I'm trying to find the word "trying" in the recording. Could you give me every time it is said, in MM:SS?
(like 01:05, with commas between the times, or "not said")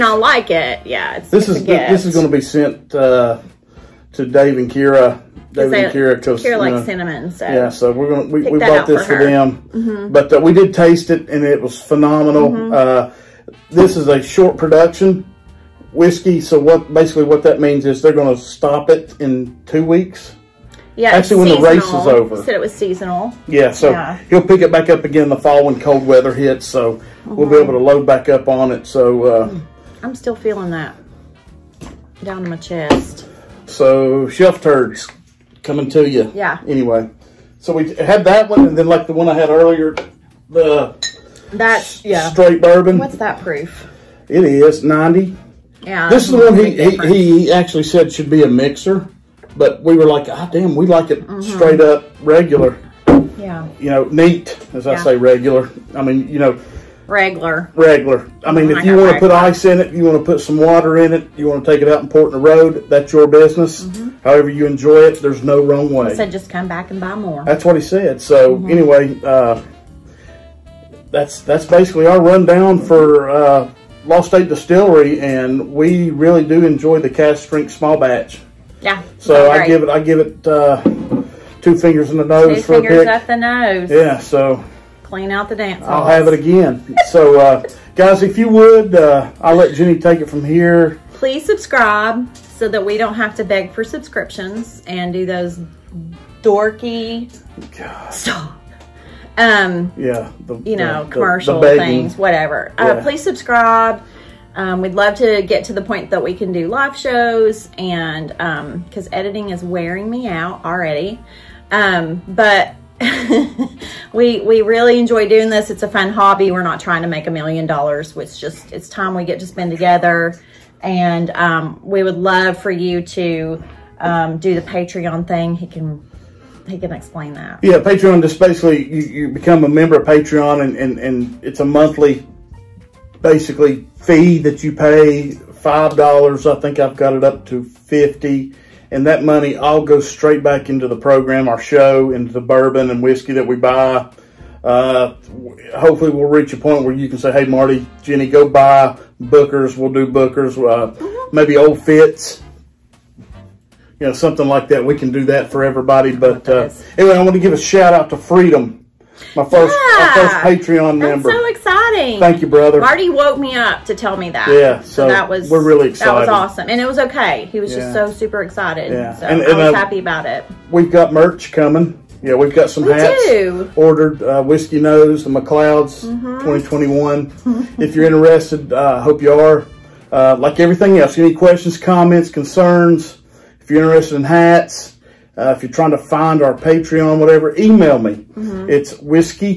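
01:56, 03:05.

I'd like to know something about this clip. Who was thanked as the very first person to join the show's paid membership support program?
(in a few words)
Freedom.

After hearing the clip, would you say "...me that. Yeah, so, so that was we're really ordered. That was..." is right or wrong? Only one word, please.
wrong.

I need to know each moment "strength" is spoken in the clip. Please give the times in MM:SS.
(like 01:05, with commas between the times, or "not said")
01:17.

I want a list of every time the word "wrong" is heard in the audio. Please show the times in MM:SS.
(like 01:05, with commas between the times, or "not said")
01:05.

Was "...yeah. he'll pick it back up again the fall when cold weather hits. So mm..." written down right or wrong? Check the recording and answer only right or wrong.
right.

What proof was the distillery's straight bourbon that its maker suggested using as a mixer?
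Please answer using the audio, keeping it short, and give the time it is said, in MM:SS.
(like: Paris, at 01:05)
90, at 00:44.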